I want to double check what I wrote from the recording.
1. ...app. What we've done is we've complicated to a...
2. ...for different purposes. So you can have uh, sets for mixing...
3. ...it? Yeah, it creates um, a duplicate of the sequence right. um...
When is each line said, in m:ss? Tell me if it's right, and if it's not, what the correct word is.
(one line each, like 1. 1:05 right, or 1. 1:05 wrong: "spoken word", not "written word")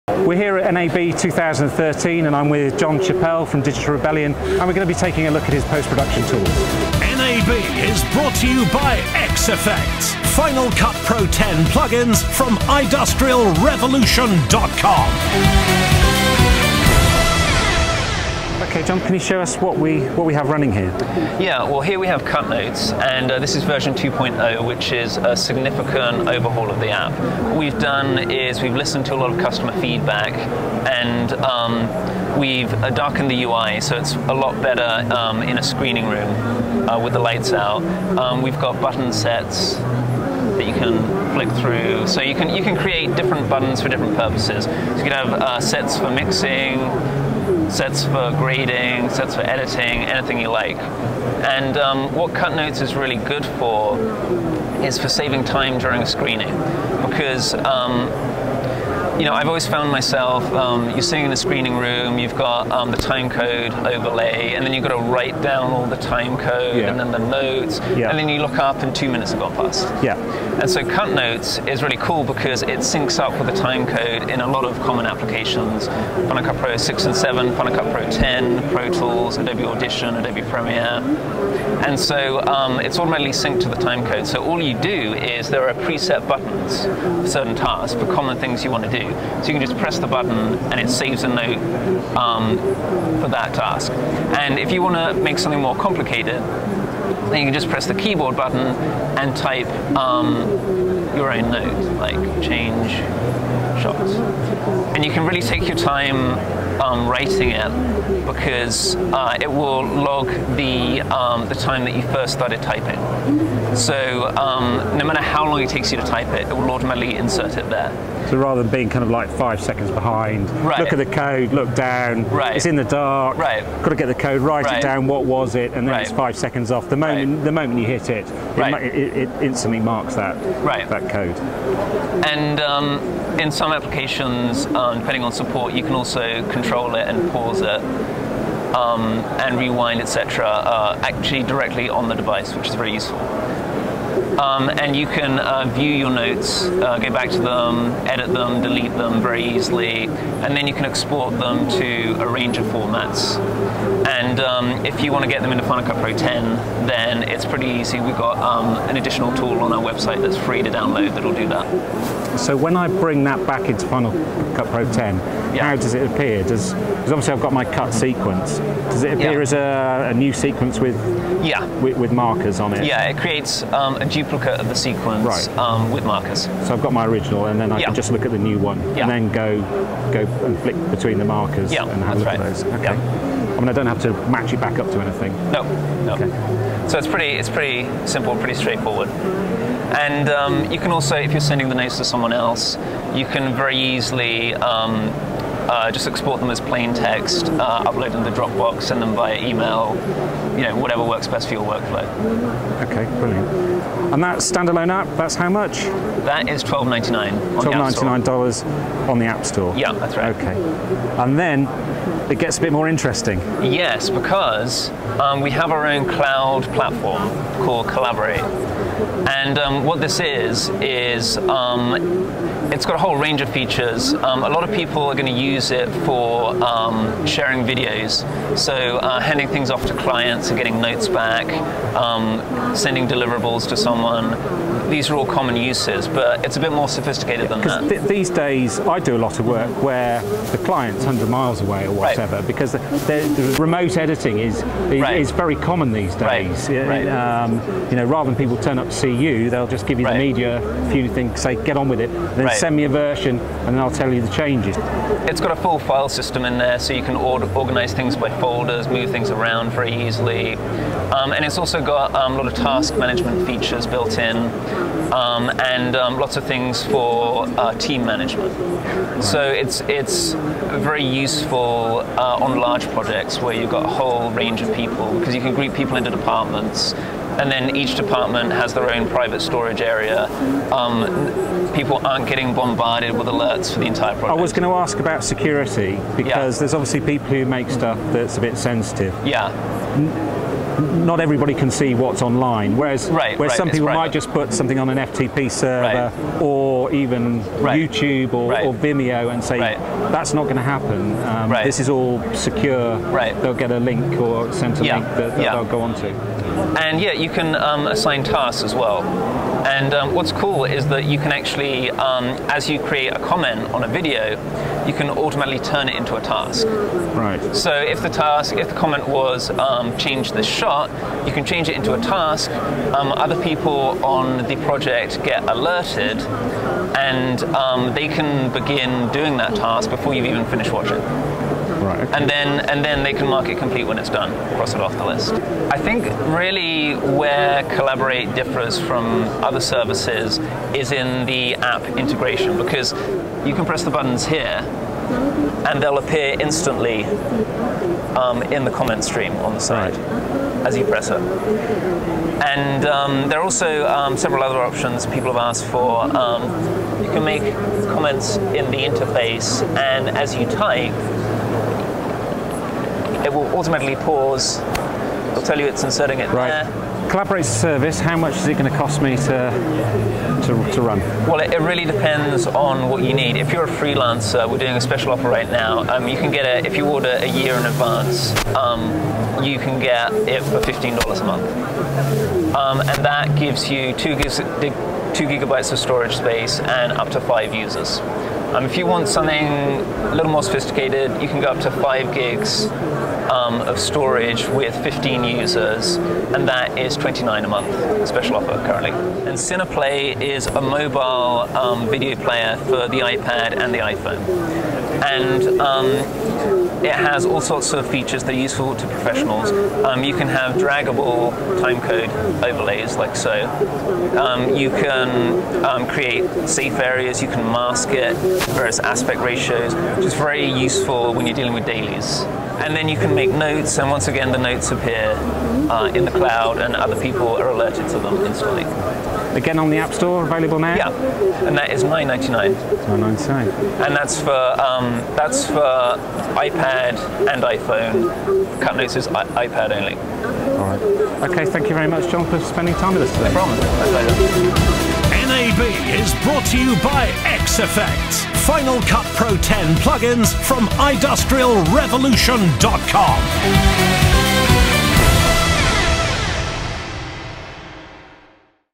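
1. 0:26 wrong: "listened", not "complicated"
2. 0:43 right
3. 2:52 right.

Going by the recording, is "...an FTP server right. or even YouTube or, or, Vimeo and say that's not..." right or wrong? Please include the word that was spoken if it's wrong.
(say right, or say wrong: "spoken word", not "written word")
right.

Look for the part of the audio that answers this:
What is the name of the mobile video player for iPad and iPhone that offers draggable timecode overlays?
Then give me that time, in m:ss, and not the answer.
6:39.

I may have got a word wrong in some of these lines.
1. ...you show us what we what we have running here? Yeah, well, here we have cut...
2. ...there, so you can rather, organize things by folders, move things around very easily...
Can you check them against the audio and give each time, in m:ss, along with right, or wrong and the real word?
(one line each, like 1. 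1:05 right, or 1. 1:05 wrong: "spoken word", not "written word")
1. 0:19 right
2. 4:16 wrong: "order", not "rather".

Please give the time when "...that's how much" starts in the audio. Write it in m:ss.
3:25.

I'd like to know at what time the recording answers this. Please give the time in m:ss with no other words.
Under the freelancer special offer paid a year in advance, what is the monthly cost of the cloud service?
6:20.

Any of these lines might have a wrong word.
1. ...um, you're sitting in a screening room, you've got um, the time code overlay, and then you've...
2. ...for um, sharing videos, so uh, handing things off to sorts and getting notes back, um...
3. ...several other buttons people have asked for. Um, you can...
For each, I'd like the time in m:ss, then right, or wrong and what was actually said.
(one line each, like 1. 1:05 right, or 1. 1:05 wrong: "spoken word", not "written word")
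1. 1:00 right
2. 3:46 wrong: "clients", not "sorts"
3. 5:54 wrong: "options", not "buttons".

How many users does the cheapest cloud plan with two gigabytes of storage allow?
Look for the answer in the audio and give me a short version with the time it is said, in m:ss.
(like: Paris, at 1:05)
5, at 6:26.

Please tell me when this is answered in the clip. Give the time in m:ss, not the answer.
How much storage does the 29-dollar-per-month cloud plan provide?
6:31.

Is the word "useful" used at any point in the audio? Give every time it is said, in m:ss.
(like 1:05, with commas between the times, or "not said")
2:22, 4:31, 6:48, 7:00.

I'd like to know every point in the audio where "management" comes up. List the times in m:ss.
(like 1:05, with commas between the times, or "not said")
4:22, 4:28.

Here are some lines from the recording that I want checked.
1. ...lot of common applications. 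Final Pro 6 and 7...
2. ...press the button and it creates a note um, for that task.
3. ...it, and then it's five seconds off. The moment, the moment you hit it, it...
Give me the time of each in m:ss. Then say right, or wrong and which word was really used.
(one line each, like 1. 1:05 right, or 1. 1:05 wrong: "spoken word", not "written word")
1. 1:14 right
2. 1:29 wrong: "saves", not "creates"
3. 2:05 right.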